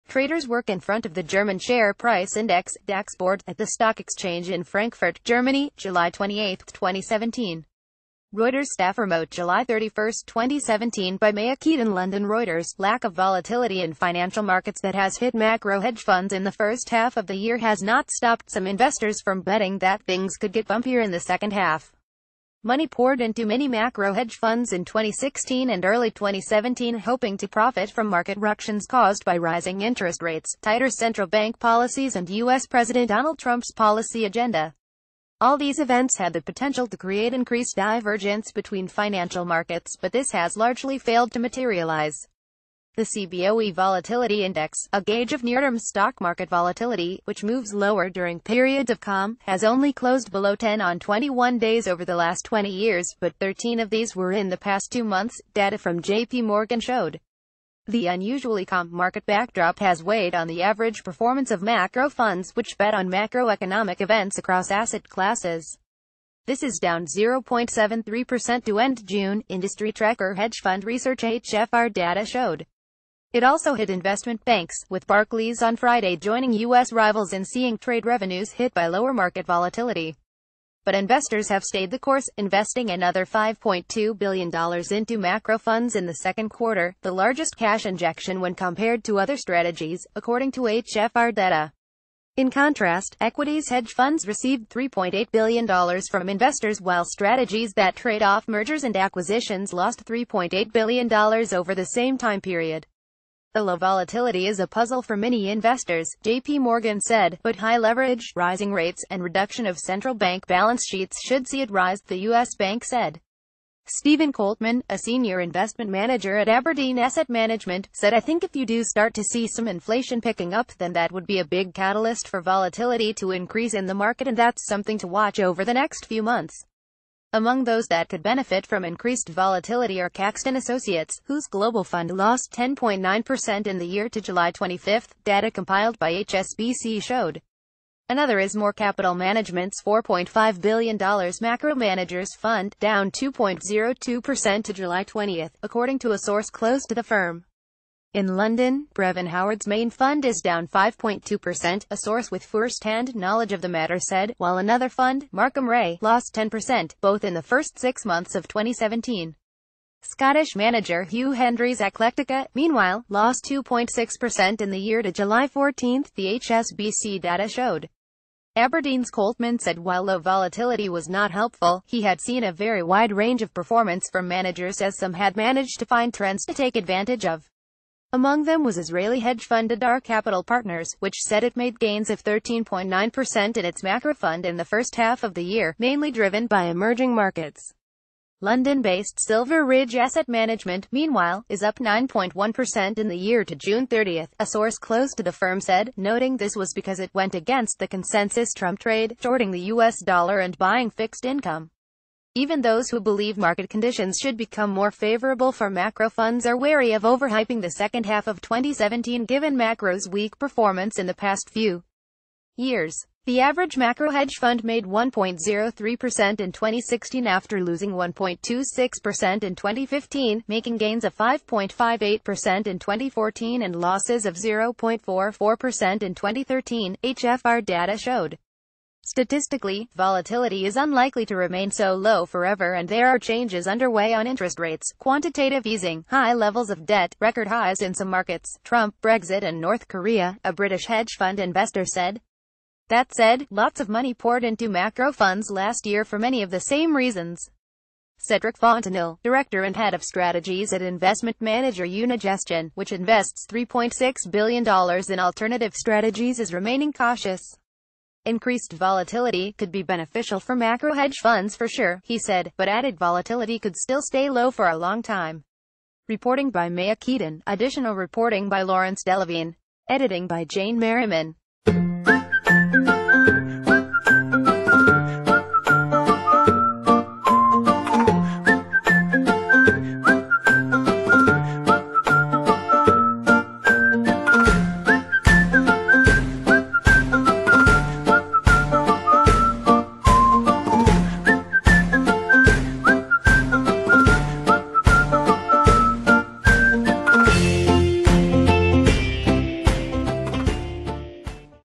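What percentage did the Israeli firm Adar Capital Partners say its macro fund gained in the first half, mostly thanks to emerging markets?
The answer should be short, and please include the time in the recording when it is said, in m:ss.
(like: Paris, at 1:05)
13.9%, at 3:02.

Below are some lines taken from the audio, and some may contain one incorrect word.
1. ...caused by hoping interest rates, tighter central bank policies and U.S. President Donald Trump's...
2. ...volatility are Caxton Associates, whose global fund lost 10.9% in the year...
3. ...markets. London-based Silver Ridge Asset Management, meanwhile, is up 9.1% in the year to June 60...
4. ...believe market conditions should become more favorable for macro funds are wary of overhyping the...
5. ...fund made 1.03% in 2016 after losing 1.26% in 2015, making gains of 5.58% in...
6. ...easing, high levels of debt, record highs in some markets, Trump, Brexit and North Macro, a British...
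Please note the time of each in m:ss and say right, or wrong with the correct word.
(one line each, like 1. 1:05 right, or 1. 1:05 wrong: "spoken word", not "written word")
1. 0:28 wrong: "rising", not "hoping"
2. 2:09 right
3. 3:07 wrong: "30", not "60"
4. 3:23 right
5. 3:34 right
6. 3:55 wrong: "Korea", not "Macro".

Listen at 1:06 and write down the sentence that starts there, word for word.
This is down 0.73% to end June, industry tracker hedge fund research HFR data showed.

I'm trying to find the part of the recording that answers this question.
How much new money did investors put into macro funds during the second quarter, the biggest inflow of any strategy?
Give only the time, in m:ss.
1:23.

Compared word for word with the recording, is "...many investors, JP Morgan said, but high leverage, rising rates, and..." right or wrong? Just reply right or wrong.
right.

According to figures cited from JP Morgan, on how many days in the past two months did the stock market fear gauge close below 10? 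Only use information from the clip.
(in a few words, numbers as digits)
13.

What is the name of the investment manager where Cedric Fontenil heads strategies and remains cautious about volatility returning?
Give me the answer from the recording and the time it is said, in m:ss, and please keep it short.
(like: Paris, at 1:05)
Unigestion, at 4:11.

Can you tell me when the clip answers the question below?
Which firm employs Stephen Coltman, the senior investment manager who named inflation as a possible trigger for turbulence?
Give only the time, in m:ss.
1:56.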